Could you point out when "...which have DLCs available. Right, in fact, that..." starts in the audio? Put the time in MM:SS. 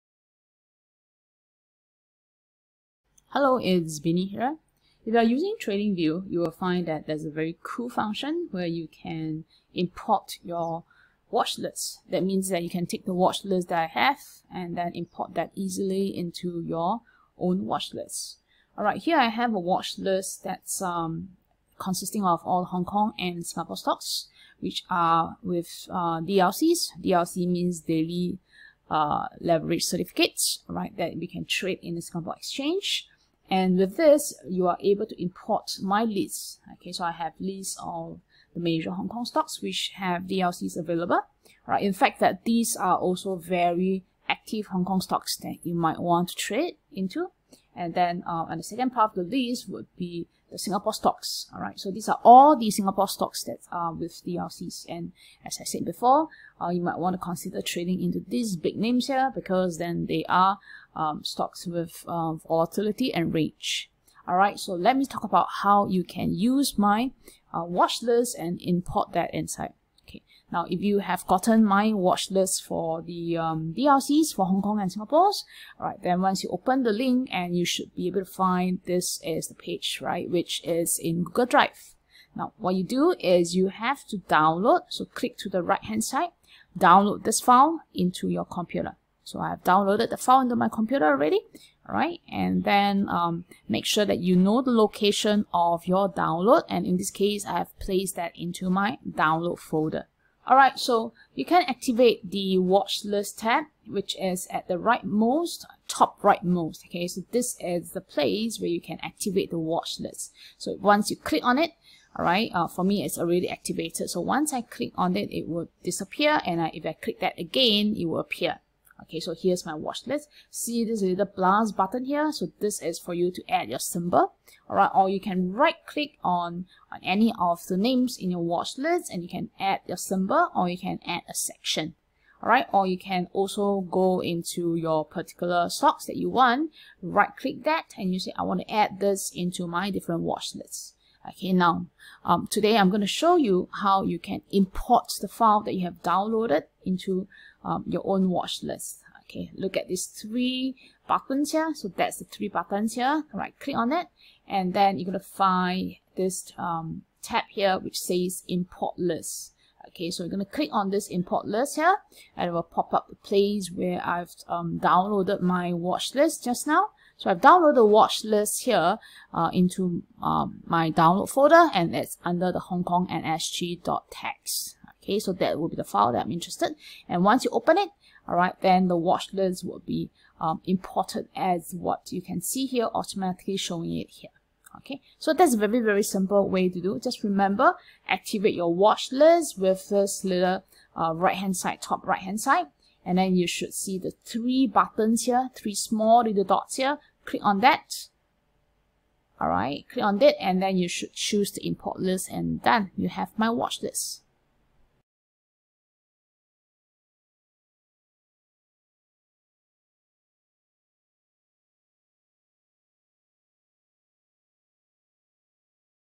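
00:39.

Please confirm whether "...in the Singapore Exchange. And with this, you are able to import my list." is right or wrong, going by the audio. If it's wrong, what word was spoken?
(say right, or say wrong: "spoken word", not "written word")
right.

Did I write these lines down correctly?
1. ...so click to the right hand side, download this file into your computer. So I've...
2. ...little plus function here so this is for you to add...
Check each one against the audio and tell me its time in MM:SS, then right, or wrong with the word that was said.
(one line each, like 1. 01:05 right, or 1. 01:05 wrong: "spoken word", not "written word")
1. 01:24 right
2. 02:01 wrong: "button", not "function".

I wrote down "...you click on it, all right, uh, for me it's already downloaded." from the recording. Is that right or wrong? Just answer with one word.
wrong.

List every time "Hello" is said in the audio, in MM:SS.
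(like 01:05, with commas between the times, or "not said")
00:03.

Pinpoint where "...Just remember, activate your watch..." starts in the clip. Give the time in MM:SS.
03:06.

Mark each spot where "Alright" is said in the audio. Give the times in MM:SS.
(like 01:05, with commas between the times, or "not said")
00:18, 03:19.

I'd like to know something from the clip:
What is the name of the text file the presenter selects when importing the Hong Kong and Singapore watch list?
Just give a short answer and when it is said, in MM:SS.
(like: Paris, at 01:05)
Hong Kong nsg.txt, at 02:52.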